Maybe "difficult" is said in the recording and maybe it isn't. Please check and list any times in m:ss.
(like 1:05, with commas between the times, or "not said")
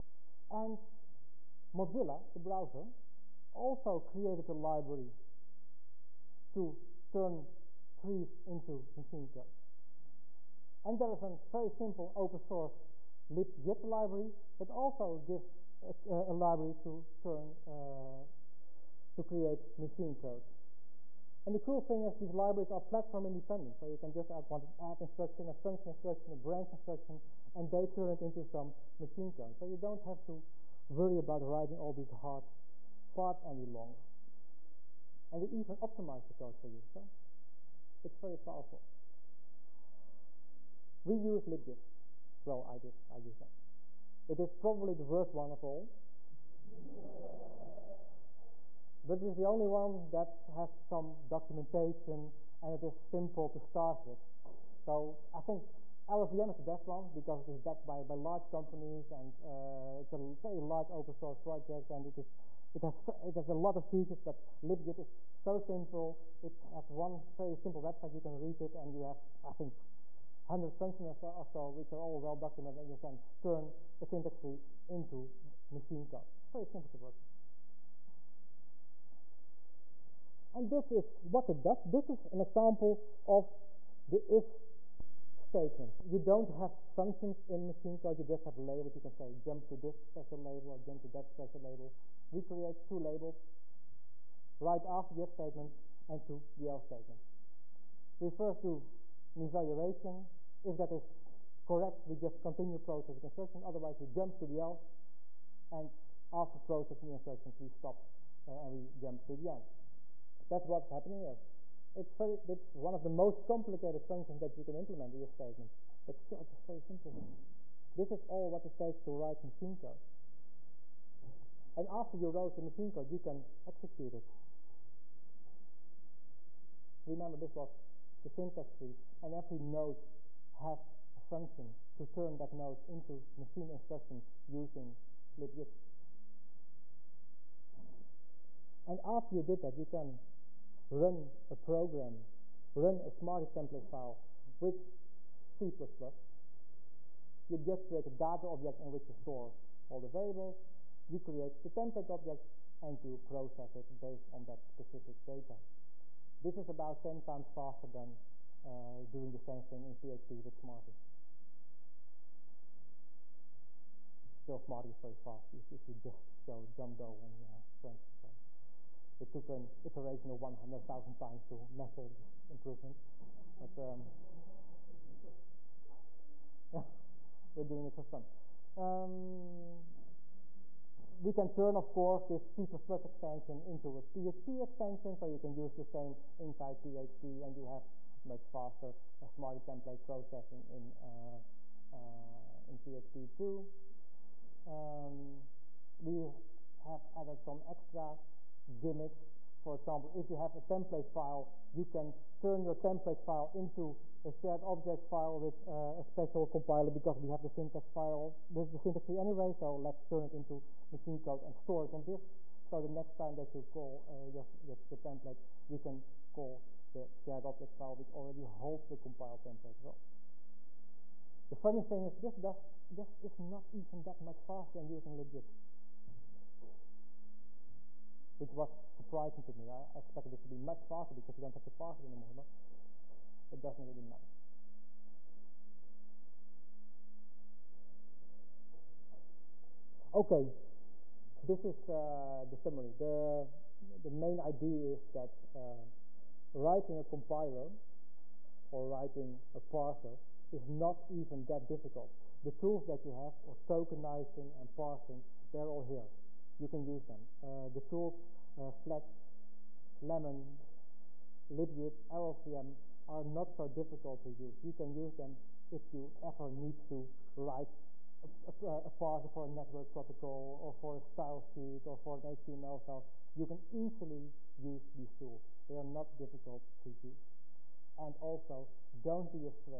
4:11, 4:23, 4:36.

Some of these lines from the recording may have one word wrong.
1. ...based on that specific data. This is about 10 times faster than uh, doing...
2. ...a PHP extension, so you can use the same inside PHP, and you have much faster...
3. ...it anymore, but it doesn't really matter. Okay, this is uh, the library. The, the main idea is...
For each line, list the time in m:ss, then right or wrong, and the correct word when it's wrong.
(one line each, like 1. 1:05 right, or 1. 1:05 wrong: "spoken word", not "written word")
1. 2:33 right
2. 3:03 right
3. 3:51 wrong: "summary", not "library".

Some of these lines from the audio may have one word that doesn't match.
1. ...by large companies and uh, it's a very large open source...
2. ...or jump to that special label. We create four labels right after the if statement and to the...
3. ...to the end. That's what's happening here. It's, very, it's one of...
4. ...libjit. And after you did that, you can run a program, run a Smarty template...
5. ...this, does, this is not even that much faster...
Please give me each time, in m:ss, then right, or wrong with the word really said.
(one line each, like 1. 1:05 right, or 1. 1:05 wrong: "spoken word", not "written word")
1. 0:58 right
2. 1:30 wrong: "two", not "four"
3. 1:49 right
4. 2:15 right
5. 3:42 right.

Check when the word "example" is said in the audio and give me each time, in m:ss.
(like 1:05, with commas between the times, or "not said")
1:22, 3:19.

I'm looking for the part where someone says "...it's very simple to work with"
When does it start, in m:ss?
1:16.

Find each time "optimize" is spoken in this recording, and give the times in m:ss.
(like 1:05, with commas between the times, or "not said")
0:35.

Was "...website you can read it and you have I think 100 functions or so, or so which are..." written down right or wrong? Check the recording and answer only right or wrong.
right.